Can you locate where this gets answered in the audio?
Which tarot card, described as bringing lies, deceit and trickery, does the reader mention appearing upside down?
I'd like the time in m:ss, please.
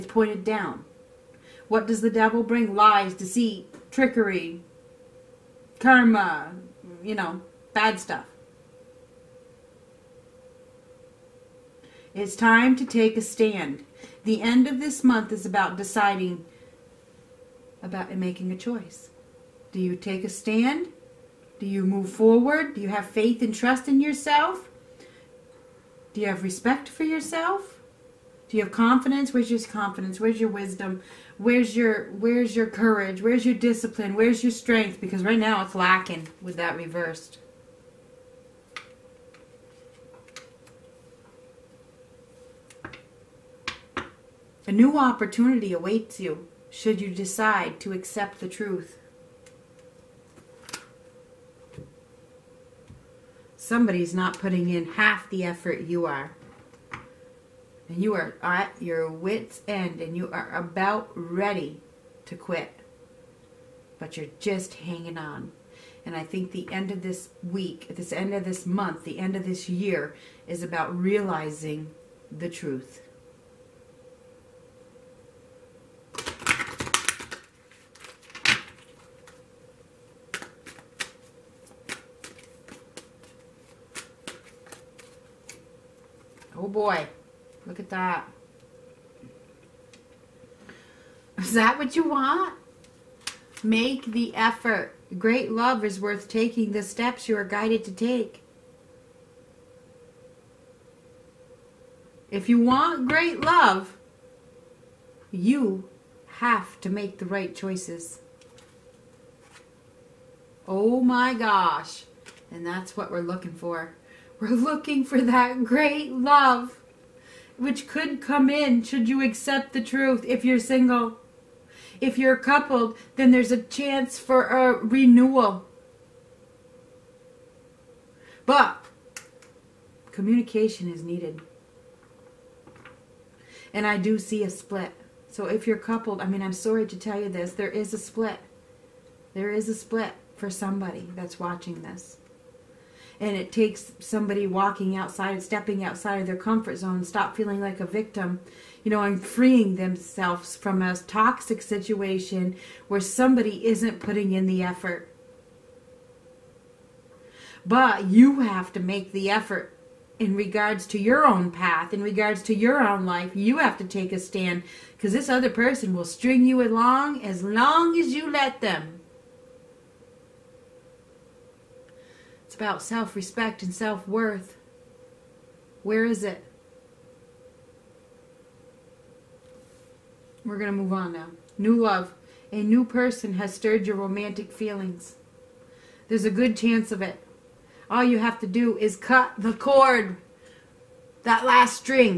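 0:02.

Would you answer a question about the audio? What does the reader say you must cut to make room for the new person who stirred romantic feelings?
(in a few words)
The cord.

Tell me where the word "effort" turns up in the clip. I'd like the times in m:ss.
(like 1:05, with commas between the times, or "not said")
0:55, 1:34, 2:34, 2:39.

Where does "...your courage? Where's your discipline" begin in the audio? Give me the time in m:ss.
0:32.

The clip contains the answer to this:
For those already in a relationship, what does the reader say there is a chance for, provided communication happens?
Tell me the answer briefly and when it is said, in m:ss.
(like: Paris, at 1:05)
A renewal, at 2:04.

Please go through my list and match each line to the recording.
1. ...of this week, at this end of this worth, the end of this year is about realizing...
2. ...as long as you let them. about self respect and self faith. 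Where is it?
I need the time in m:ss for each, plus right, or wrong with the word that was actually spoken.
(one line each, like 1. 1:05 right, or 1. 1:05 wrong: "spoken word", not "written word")
1. 1:06 wrong: "month", not "worth"
2. 2:47 wrong: "worth", not "faith".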